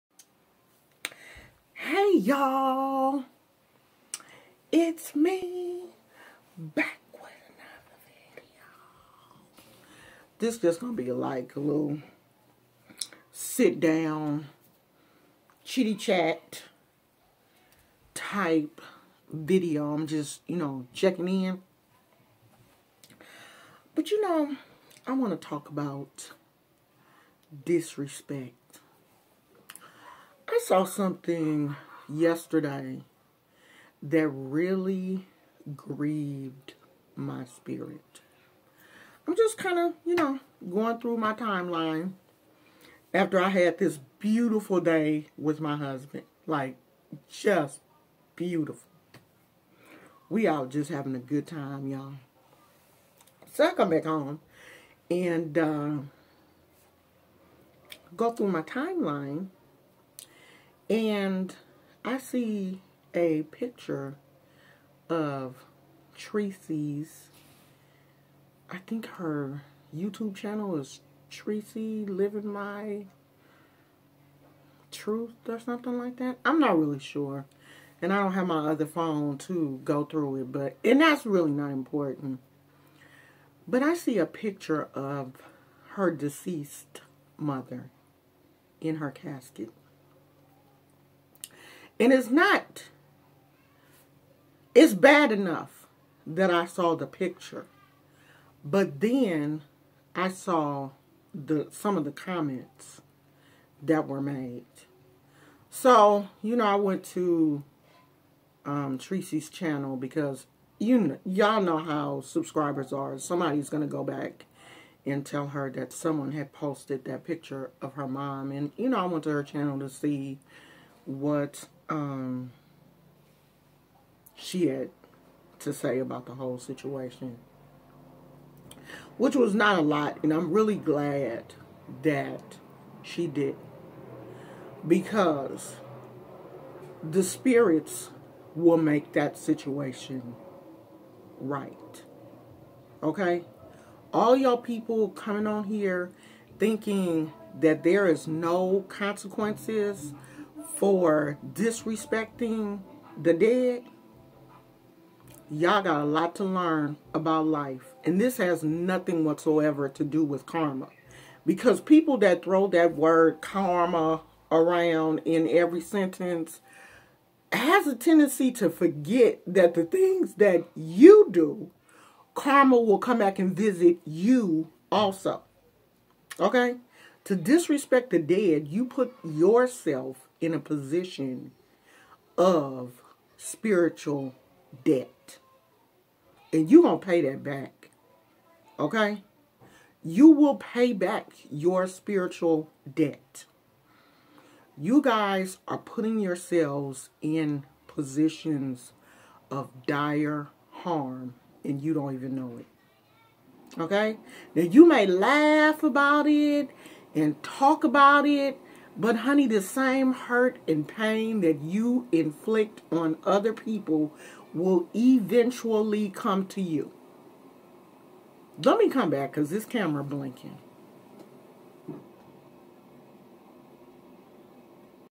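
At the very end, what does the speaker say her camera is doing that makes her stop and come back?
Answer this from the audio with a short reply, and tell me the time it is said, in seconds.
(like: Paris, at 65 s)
Blinking, at 220 s.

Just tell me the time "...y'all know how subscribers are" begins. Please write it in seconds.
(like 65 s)
111 s.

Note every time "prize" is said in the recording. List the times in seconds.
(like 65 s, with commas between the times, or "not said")
not said.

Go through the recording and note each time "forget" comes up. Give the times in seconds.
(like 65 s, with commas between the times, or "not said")
168 s.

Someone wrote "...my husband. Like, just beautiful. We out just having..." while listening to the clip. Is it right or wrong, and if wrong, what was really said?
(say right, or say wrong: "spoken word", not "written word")
right.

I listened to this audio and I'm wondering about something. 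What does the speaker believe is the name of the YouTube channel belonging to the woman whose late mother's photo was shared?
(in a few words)
Tracy Living My Truth.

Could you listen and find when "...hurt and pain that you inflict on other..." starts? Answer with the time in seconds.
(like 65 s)
210 s.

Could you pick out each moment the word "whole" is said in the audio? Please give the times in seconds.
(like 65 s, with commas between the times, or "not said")
126 s.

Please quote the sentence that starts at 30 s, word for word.
I saw something yesterday that really grieved my spirit.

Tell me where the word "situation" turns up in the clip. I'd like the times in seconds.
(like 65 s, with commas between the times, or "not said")
126 s, 139 s.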